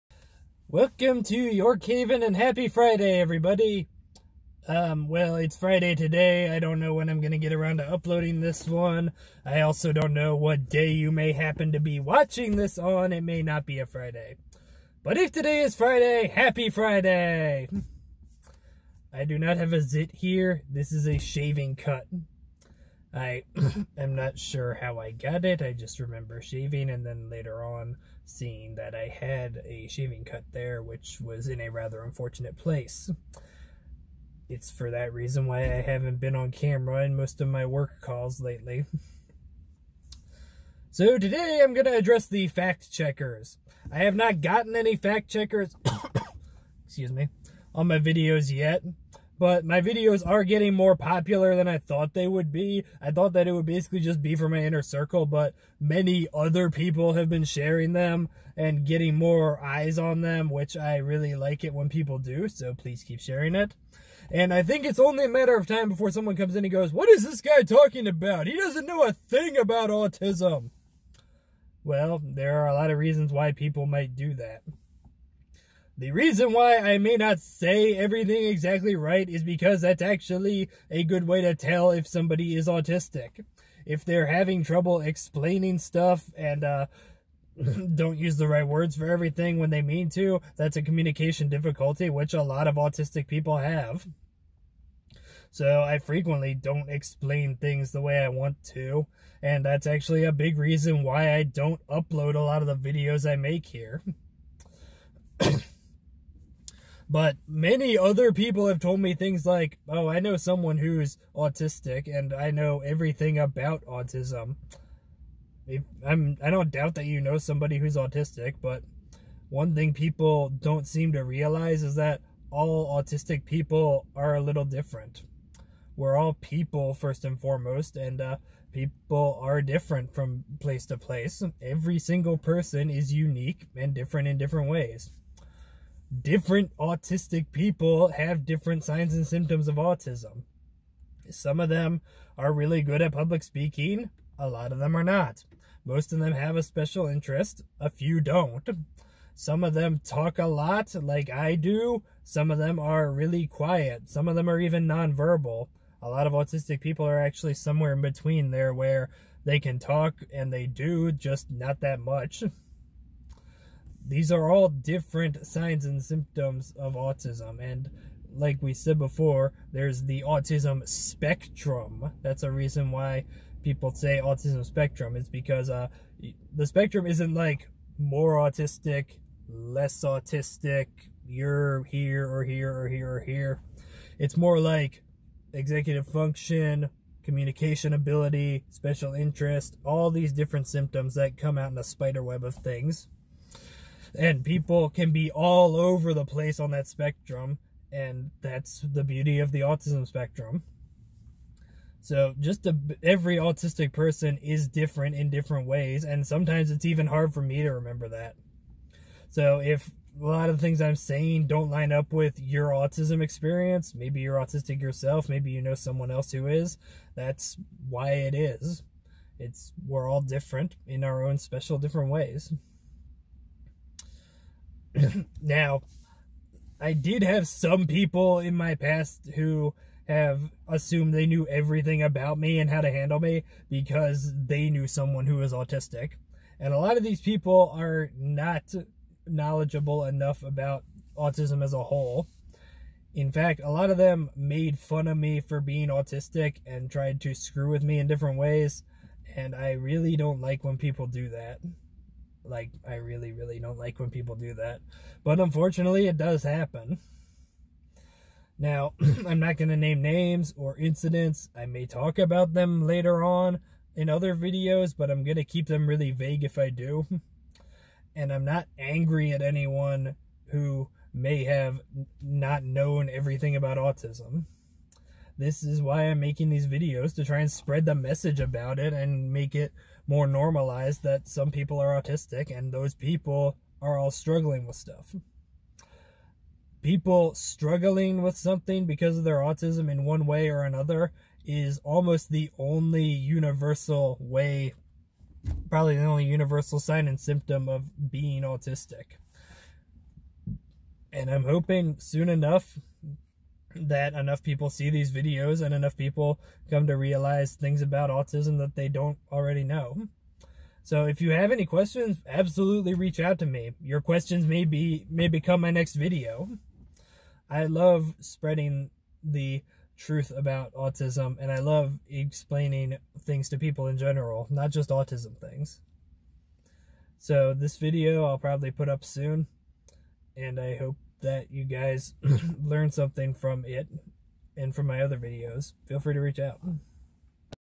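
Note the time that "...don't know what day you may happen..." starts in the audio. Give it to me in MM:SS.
00:09.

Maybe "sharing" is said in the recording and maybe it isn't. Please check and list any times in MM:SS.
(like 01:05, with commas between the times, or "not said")
00:57, 01:03.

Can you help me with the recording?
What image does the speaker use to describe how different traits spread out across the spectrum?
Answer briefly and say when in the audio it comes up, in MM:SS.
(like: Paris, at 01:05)
Spider web, at 03:11.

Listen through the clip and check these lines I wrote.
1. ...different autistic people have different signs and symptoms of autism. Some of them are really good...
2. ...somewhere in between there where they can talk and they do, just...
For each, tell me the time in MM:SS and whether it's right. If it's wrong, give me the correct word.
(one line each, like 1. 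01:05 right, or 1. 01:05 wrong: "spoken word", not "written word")
1. 02:16 right
2. 02:37 right.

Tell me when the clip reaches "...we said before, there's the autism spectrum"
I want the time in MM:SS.
02:48.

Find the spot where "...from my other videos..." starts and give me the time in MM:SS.
05:34.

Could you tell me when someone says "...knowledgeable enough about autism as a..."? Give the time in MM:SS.
03:59.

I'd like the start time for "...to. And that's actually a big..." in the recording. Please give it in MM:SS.
01:38.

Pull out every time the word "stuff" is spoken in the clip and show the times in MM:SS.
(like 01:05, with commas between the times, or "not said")
01:25, 04:44.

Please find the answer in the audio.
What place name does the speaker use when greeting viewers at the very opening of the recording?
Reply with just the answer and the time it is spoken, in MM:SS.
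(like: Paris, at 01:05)
York Haven, at 00:01.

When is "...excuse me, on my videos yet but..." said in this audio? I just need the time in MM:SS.
00:46.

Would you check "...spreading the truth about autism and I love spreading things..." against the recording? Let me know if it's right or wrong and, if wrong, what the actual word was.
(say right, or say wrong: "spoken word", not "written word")
wrong: "explaining", not "spreading".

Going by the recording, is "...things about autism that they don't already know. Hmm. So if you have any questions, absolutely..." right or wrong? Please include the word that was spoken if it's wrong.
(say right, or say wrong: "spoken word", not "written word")
right.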